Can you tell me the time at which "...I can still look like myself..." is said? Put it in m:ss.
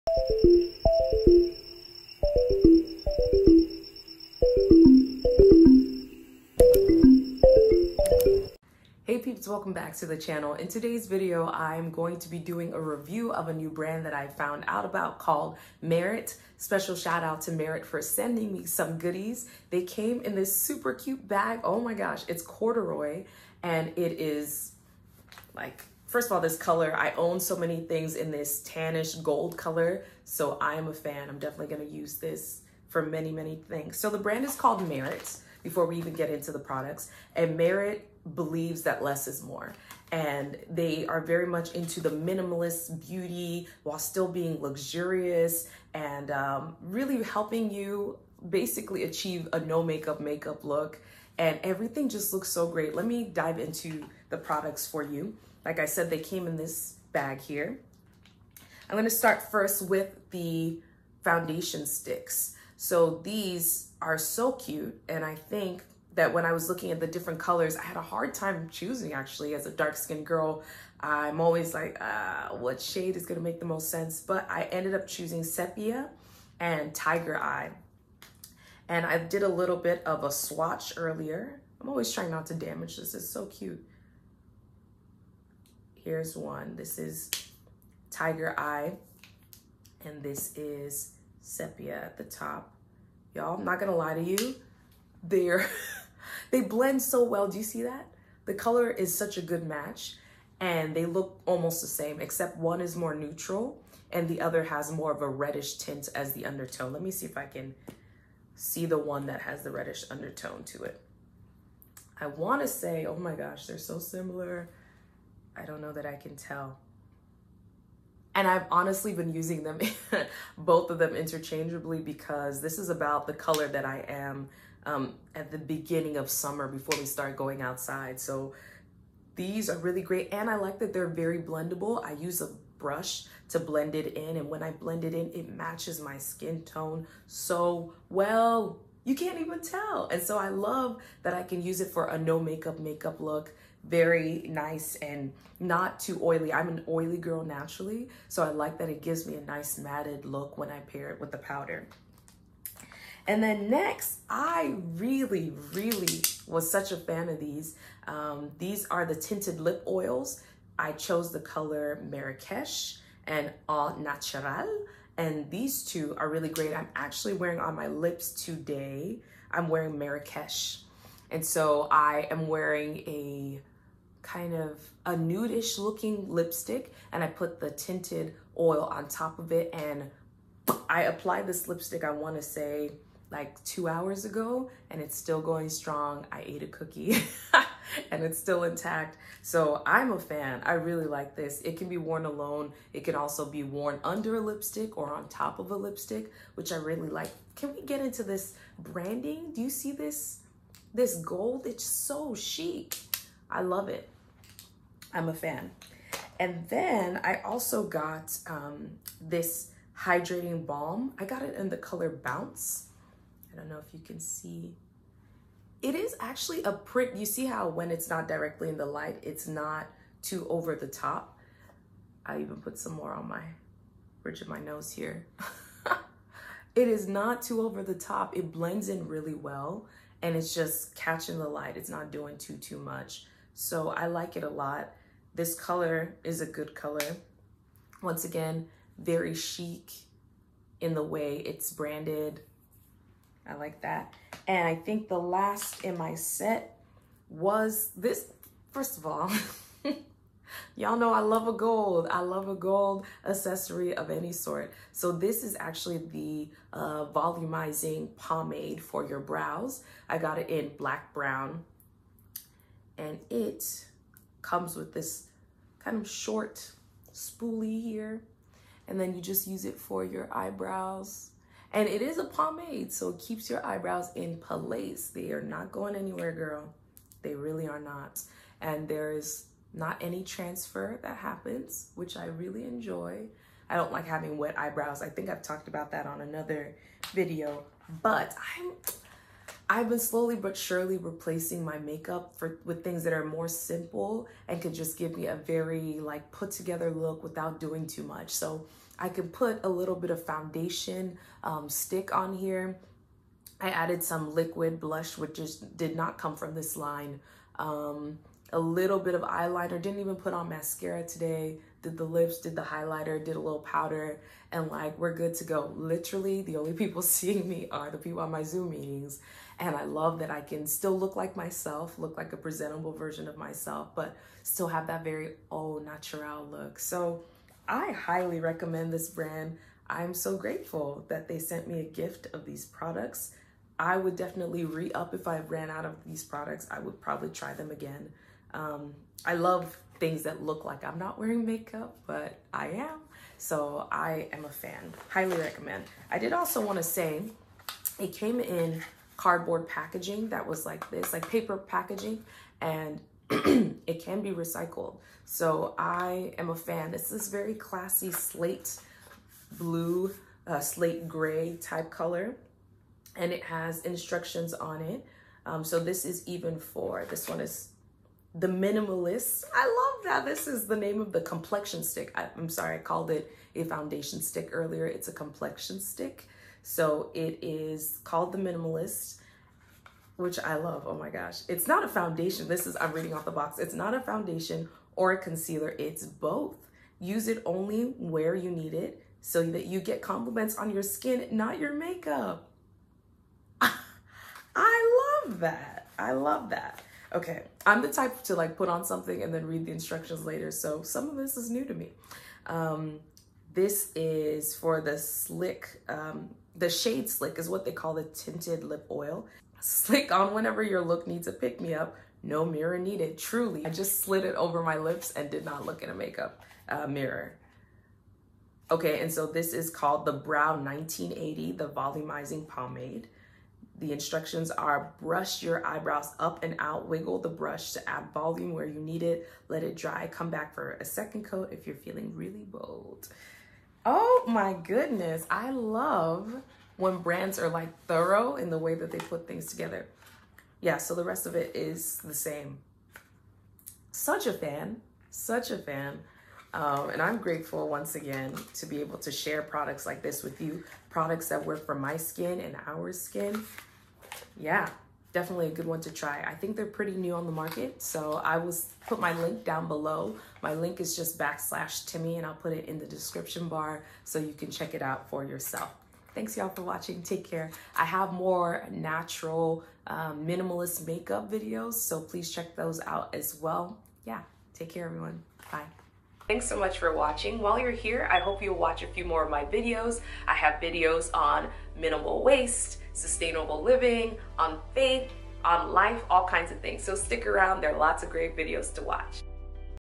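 5:20.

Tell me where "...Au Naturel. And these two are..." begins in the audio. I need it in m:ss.
2:43.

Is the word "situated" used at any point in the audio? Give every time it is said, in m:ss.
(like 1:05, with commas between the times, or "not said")
not said.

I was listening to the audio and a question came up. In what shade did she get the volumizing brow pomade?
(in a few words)
Black brown.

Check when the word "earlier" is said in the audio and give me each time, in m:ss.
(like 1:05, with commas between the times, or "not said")
1:20, 6:14.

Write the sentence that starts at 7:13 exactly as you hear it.
Oh my goodness, I love when brands are like thorough in the way that they put things together.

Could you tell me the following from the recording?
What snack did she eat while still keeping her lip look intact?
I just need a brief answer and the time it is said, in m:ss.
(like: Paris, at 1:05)
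A cookie, at 3:06.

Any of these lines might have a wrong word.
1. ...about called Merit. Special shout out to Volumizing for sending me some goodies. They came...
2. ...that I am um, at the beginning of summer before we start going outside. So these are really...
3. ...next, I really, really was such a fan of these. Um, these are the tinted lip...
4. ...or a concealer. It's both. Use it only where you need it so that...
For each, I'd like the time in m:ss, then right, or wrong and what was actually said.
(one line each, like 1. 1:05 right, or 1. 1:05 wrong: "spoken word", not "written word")
1. 0:14 wrong: "Merit", not "Volumizing"
2. 2:03 right
3. 2:33 right
4. 6:24 right.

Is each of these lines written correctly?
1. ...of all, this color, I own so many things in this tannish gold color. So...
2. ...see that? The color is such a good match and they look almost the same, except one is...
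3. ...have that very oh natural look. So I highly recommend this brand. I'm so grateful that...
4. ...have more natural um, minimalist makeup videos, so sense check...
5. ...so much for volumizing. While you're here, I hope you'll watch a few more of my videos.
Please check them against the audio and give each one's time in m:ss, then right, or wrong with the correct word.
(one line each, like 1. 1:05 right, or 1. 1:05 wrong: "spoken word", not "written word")
1. 0:26 right
2. 1:37 right
3. 5:24 right
4. 7:47 wrong: "please", not "sense"
5. 7:56 wrong: "watching", not "volumizing".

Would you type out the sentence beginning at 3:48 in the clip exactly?
It blends in really well and it's just catching the light.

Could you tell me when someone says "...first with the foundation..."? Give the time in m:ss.
0:59.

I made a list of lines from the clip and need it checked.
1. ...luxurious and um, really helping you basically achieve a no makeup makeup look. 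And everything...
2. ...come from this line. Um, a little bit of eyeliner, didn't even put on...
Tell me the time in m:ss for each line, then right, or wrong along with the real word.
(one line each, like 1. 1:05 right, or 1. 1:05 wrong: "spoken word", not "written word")
1. 0:44 right
2. 5:06 right.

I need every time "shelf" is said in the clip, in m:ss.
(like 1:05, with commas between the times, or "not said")
not said.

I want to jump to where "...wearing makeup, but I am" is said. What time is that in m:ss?
5:41.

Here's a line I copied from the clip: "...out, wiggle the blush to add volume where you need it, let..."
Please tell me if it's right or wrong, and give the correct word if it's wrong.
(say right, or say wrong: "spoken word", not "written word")
wrong: "brush", not "blush".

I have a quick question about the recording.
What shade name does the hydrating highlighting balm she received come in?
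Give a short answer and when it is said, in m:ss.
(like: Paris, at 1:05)
Bounce, at 3:32.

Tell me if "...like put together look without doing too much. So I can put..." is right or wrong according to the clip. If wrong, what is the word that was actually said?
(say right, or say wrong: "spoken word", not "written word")
right.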